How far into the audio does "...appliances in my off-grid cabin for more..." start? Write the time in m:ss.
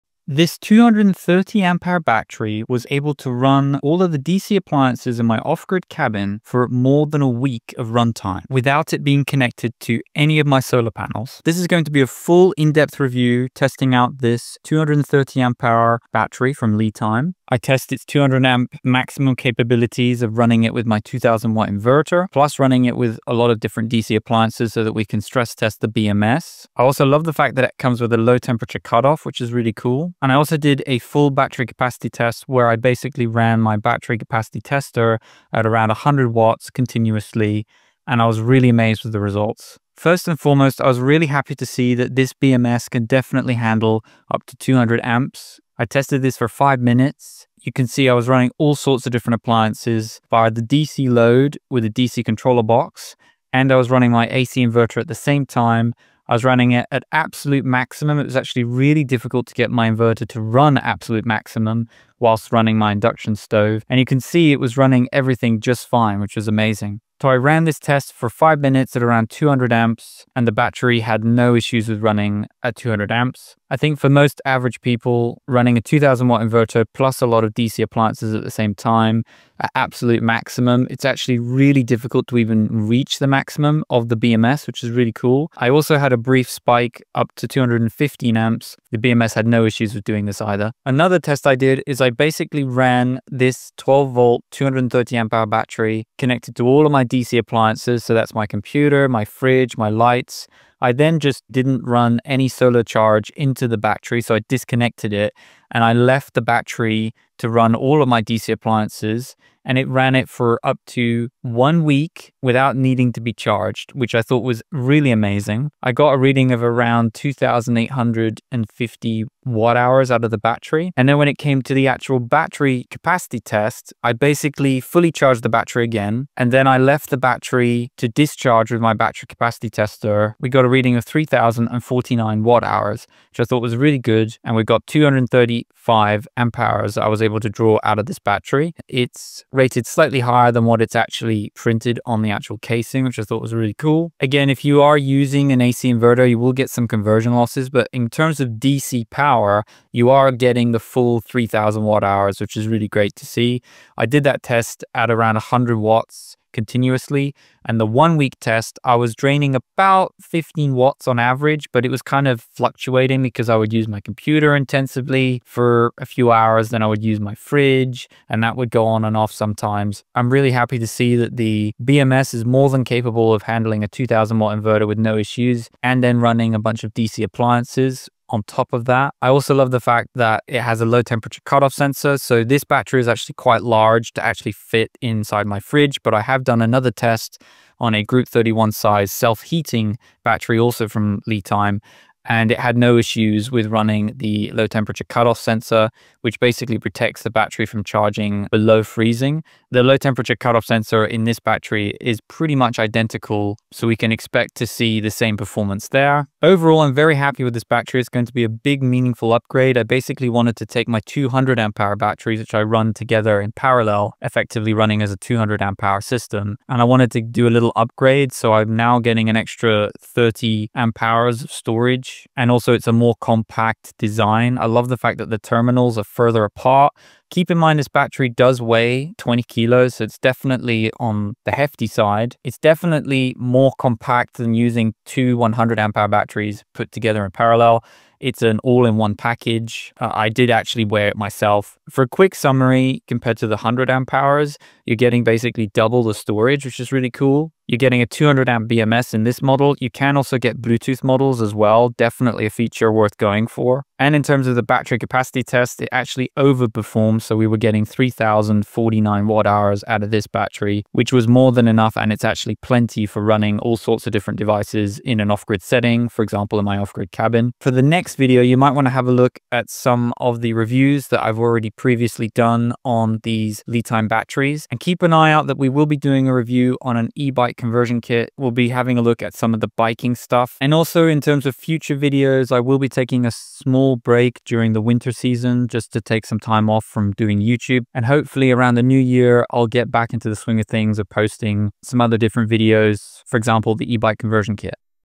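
0:04.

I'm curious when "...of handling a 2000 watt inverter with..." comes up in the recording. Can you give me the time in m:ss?
2:53.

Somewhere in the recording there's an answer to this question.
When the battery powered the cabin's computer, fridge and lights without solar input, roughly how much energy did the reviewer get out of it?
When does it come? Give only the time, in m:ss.
1:57.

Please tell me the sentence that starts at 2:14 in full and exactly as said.
And we got 230 Five amp hours I was able to draw out of this battery.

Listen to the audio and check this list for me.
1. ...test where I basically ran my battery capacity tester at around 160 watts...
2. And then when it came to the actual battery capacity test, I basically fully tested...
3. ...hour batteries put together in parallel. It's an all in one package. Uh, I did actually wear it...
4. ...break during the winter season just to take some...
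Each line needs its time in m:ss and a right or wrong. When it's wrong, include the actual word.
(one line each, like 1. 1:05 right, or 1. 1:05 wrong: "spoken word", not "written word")
1. 0:32 wrong: "100", not "160"
2. 2:00 wrong: "charged", not "tested"
3. 3:55 right
4. 4:43 right.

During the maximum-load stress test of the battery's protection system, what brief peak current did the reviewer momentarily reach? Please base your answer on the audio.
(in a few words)
215 amps.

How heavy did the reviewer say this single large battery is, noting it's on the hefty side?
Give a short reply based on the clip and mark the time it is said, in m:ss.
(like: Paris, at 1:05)
20 kilos, at 3:49.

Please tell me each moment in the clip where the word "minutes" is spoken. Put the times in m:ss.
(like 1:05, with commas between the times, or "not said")
0:46, 1:08.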